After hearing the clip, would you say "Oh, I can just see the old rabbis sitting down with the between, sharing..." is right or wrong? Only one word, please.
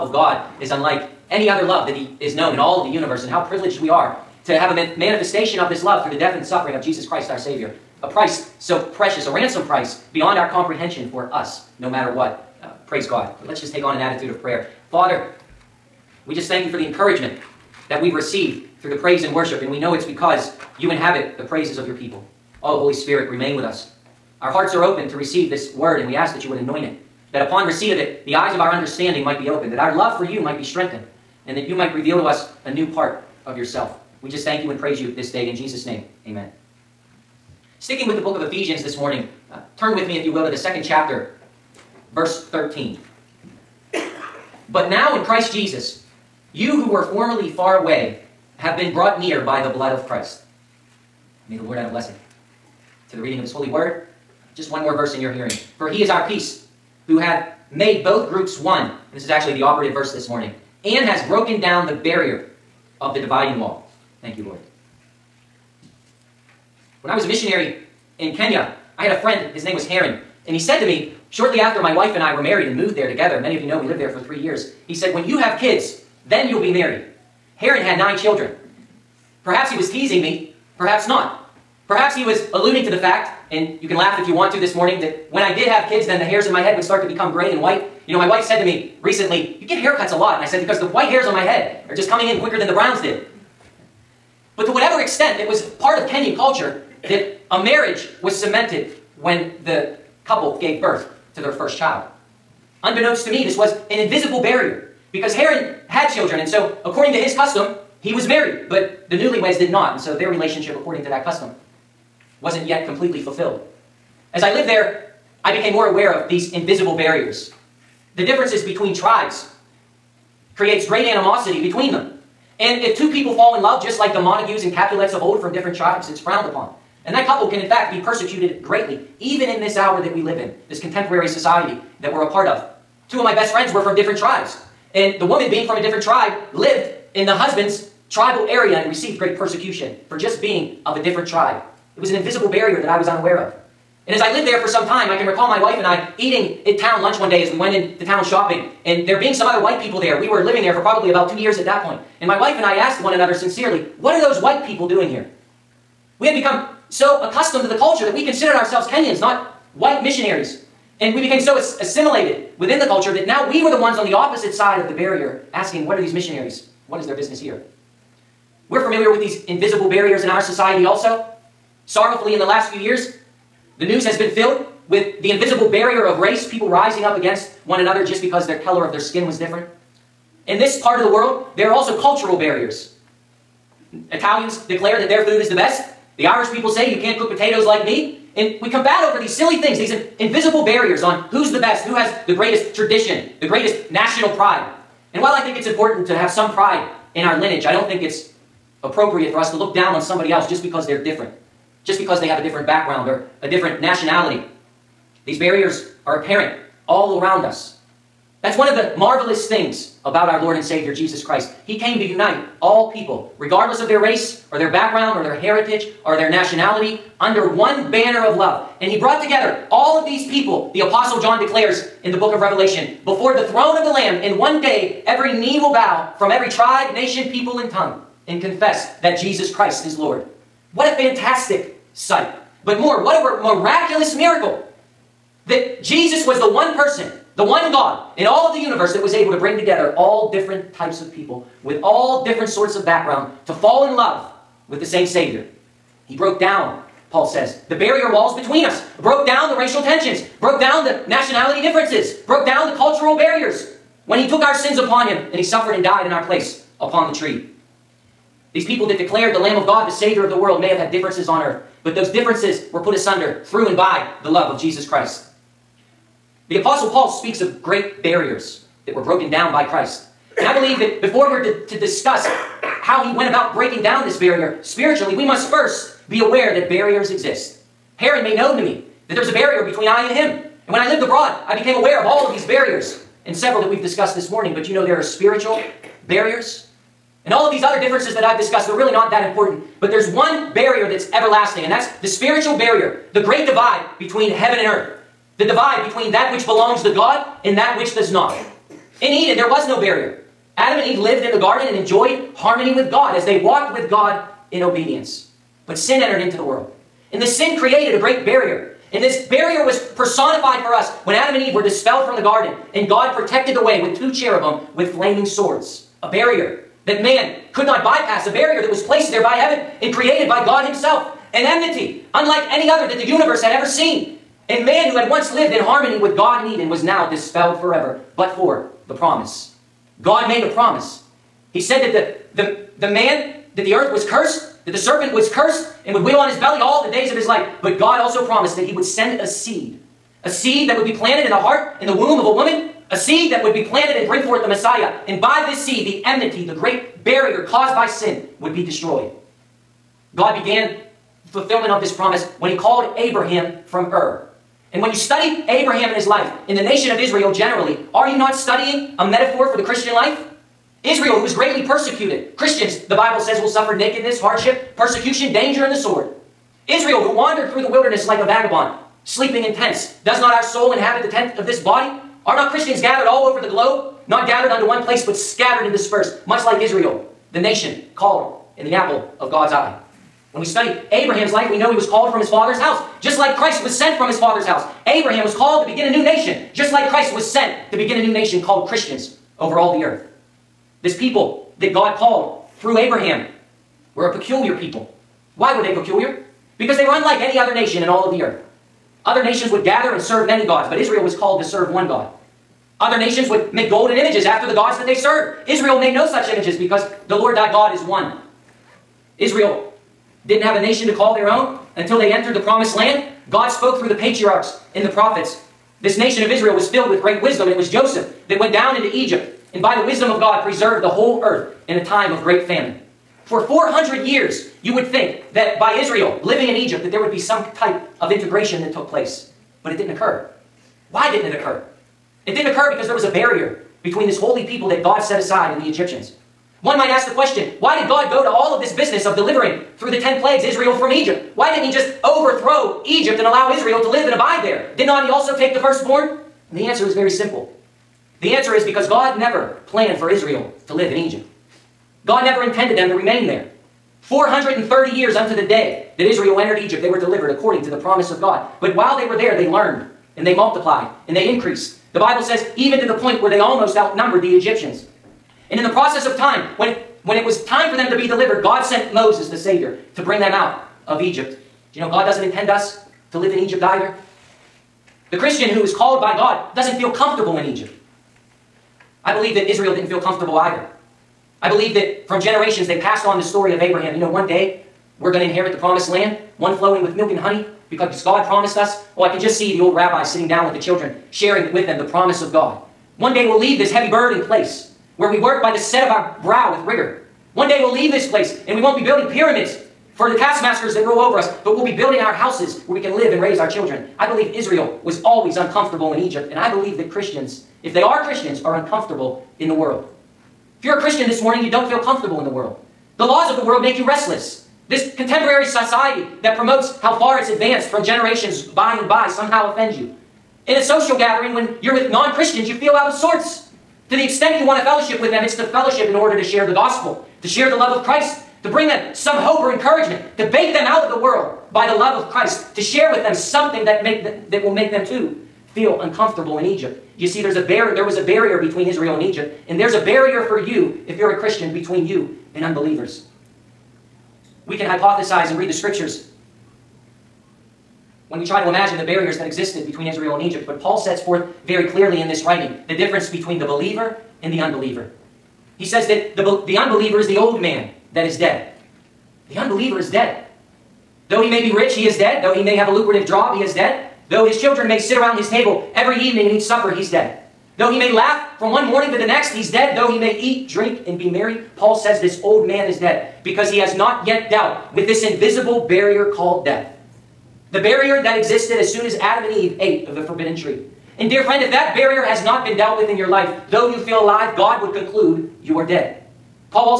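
wrong.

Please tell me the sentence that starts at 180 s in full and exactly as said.
In this part of the world, there are also cultural barriers.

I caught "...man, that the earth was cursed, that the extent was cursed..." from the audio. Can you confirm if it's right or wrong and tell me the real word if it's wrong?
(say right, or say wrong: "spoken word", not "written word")
wrong: "serpent", not "extent".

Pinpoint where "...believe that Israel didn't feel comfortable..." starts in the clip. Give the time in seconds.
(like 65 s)
479 s.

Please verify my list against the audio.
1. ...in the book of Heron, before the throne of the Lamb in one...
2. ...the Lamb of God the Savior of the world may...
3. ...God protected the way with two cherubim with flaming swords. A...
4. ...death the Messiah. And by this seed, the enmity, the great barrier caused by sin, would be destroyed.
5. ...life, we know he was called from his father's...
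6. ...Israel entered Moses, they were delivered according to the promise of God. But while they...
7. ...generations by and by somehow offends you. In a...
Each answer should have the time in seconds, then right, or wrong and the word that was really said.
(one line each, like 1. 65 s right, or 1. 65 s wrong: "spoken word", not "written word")
1. 222 s wrong: "Revelation", not "Heron"
2. 259 s right
3. 312 s right
4. 344 s wrong: "forth", not "death"
5. 381 s right
6. 456 s wrong: "Egypt", not "Moses"
7. 517 s right.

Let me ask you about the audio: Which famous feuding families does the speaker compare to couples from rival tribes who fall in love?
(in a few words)
Montagues and Capulets.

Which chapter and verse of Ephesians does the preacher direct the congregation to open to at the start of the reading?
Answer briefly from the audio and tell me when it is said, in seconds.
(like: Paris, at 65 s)
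Chapter 2, verse 13, at 40 s.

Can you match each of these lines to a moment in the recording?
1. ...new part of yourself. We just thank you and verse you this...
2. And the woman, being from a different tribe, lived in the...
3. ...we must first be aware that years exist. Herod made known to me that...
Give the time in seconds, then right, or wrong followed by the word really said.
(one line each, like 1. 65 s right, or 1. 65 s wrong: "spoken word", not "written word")
1. 32 s wrong: "praise", not "verse"
2. 134 s right
3. 275 s wrong: "barriers", not "years".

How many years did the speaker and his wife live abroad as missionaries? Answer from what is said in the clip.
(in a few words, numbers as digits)
3.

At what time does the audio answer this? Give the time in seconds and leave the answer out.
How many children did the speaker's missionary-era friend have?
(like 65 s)
77 s.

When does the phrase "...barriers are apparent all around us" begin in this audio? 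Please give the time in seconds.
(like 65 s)
205 s.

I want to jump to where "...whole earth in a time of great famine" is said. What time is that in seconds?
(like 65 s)
420 s.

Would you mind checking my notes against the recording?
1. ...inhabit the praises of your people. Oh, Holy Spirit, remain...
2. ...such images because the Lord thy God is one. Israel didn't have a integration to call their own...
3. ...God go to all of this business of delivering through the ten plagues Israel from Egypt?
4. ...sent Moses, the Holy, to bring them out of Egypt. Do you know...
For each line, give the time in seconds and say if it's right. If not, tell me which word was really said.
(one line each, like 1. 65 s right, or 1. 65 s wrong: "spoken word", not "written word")
1. 20 s right
2. 406 s wrong: "nation", not "integration"
3. 437 s right
4. 468 s wrong: "Savior", not "Holy".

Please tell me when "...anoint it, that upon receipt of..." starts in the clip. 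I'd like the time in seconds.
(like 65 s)
26 s.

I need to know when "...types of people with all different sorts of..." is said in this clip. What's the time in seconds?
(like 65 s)
240 s.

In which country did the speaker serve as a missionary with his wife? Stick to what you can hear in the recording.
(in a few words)
Kenya.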